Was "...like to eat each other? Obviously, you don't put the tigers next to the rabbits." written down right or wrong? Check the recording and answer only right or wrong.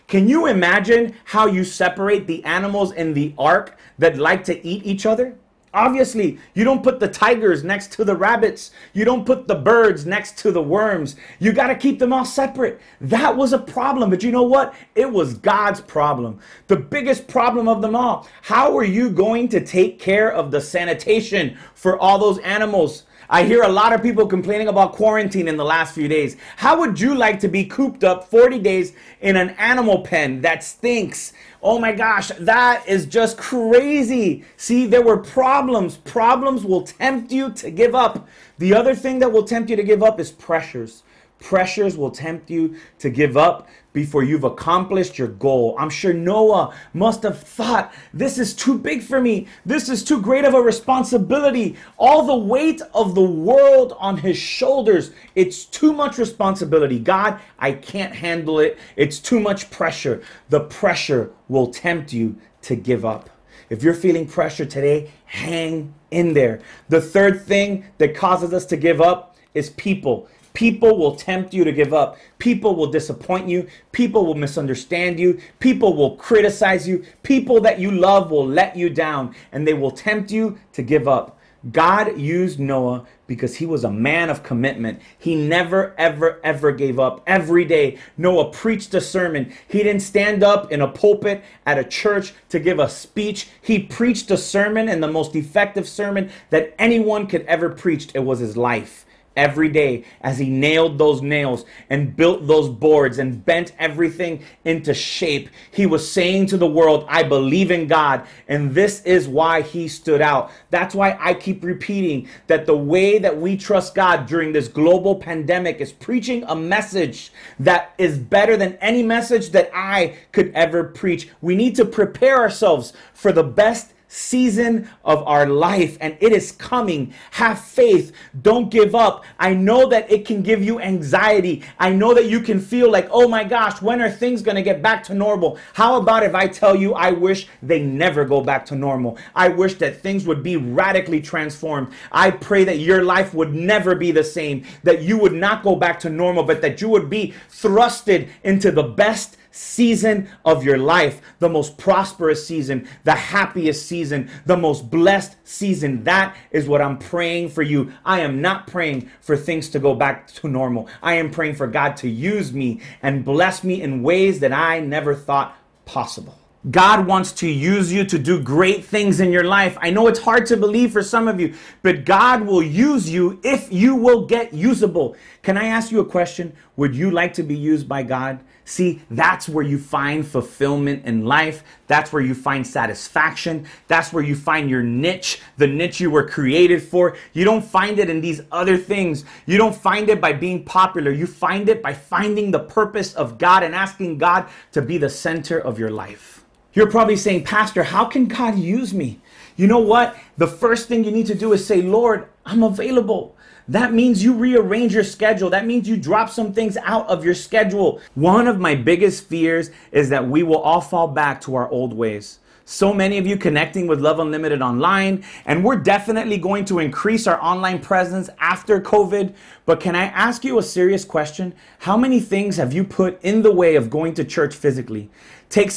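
right.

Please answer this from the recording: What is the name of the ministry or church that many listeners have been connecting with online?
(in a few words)
Love Unlimited.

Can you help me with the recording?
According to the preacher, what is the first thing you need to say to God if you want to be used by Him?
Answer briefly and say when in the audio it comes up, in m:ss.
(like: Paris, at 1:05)
Lord, I'm available, at 3:21.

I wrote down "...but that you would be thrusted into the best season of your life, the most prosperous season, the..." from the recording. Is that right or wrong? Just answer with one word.
right.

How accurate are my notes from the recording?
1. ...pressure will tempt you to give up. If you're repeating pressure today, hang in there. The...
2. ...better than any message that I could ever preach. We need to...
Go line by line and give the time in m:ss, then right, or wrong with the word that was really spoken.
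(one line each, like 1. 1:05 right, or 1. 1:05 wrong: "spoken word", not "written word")
1. 1:00 wrong: "feeling", not "repeating"
2. 1:58 right.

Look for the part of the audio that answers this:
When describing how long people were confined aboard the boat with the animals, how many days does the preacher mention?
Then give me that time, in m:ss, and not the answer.
0:28.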